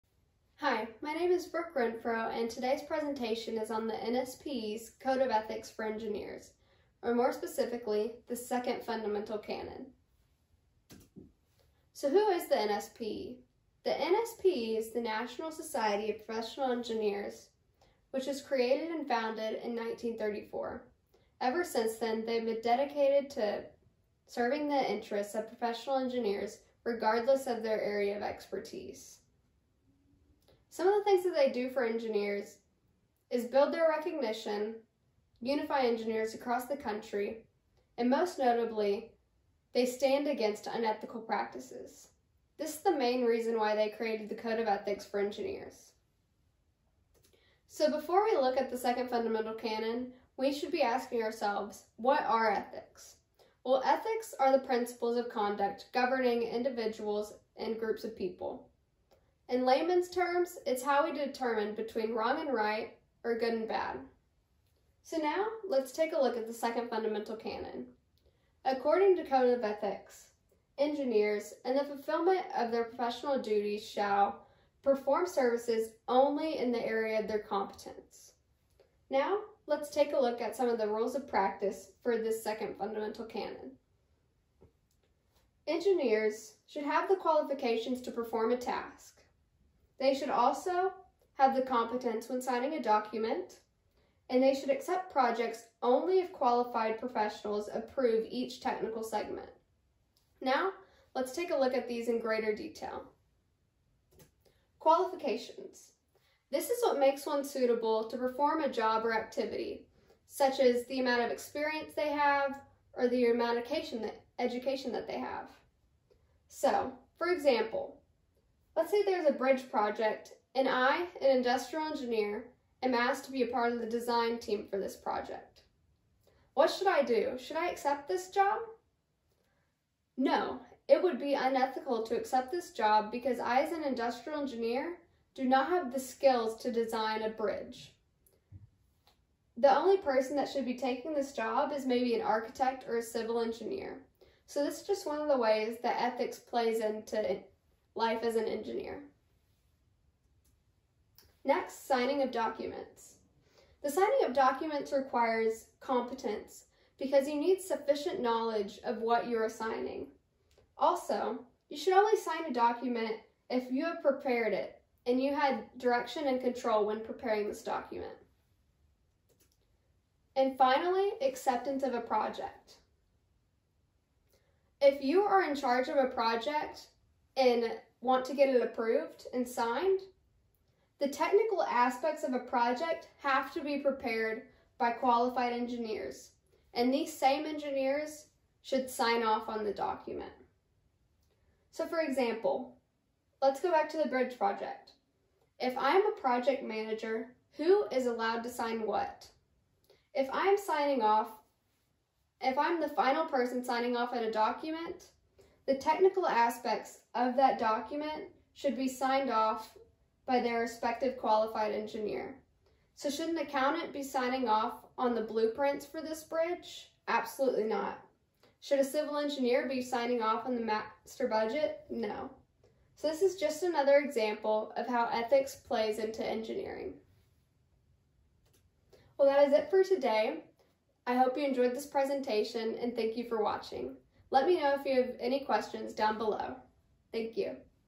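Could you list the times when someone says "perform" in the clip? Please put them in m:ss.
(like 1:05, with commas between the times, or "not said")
1:14, 1:28, 1:48.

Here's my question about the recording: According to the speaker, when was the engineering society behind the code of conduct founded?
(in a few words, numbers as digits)
1934.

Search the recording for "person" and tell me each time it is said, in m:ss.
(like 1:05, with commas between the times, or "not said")
2:19, 3:23.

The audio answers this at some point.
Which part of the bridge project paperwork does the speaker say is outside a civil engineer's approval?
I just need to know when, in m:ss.
3:40.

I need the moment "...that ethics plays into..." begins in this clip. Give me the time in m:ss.
2:25.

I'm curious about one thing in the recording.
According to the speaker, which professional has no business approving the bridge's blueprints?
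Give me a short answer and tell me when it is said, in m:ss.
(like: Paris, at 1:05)
An accountant, at 3:33.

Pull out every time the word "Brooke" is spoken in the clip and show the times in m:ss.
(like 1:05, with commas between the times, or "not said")
0:01.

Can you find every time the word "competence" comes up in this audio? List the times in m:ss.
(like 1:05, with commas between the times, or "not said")
1:17, 1:31, 2:35.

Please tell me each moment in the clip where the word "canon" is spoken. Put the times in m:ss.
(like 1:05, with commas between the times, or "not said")
0:09, 0:49, 1:07, 1:23.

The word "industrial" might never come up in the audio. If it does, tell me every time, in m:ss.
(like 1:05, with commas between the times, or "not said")
2:01, 2:13.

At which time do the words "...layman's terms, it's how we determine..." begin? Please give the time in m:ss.
0:59.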